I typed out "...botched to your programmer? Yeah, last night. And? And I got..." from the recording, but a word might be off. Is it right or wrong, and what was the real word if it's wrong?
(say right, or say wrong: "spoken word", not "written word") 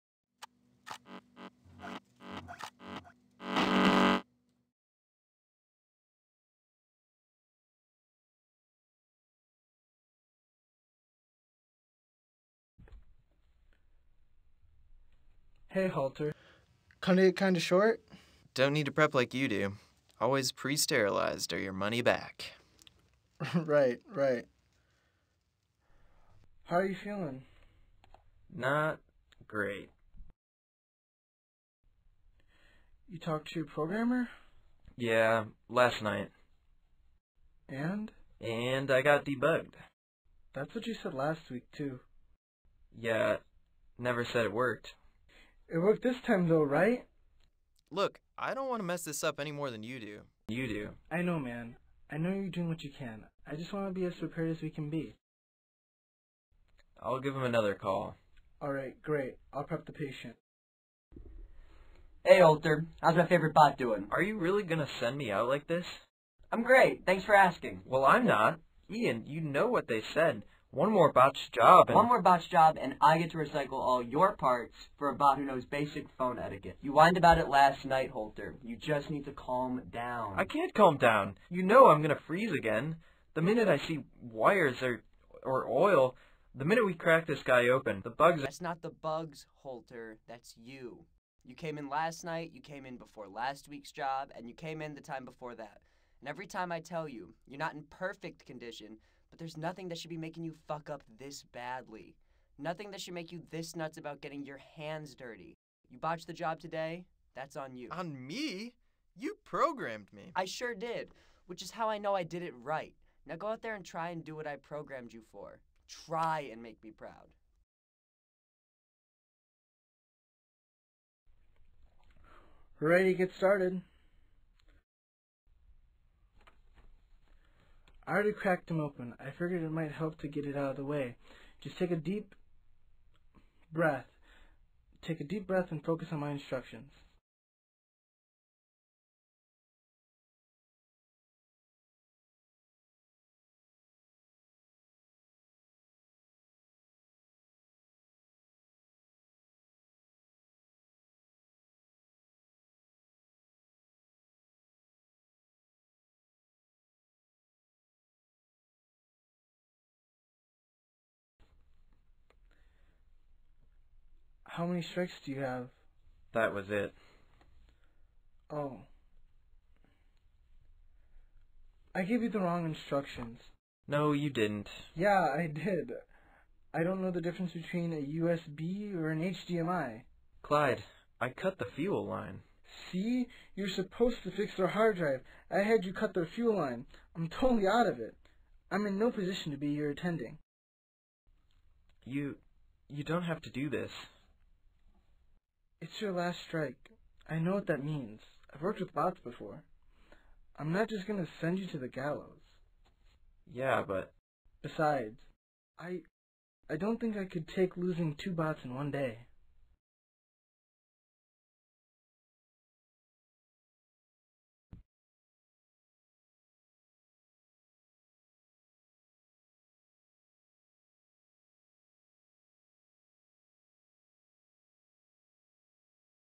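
wrong: "talked", not "botched".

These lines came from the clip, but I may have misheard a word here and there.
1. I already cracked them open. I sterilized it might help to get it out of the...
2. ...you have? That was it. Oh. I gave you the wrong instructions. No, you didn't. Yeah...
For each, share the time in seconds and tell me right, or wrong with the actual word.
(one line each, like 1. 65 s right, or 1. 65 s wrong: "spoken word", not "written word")
1. 128 s wrong: "figured", not "sterilized"
2. 165 s right.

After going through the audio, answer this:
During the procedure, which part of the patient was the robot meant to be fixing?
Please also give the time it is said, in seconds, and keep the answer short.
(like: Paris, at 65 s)
hard drive, at 184 s.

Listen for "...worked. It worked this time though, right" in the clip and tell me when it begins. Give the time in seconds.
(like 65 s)
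44 s.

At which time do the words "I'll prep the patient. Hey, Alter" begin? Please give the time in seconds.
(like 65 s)
59 s.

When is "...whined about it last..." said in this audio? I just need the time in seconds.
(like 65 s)
76 s.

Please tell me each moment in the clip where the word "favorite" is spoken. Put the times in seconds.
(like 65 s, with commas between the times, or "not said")
63 s.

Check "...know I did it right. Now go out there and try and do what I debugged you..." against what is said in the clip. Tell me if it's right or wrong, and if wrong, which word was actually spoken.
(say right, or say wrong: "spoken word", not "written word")
wrong: "programmed", not "debugged".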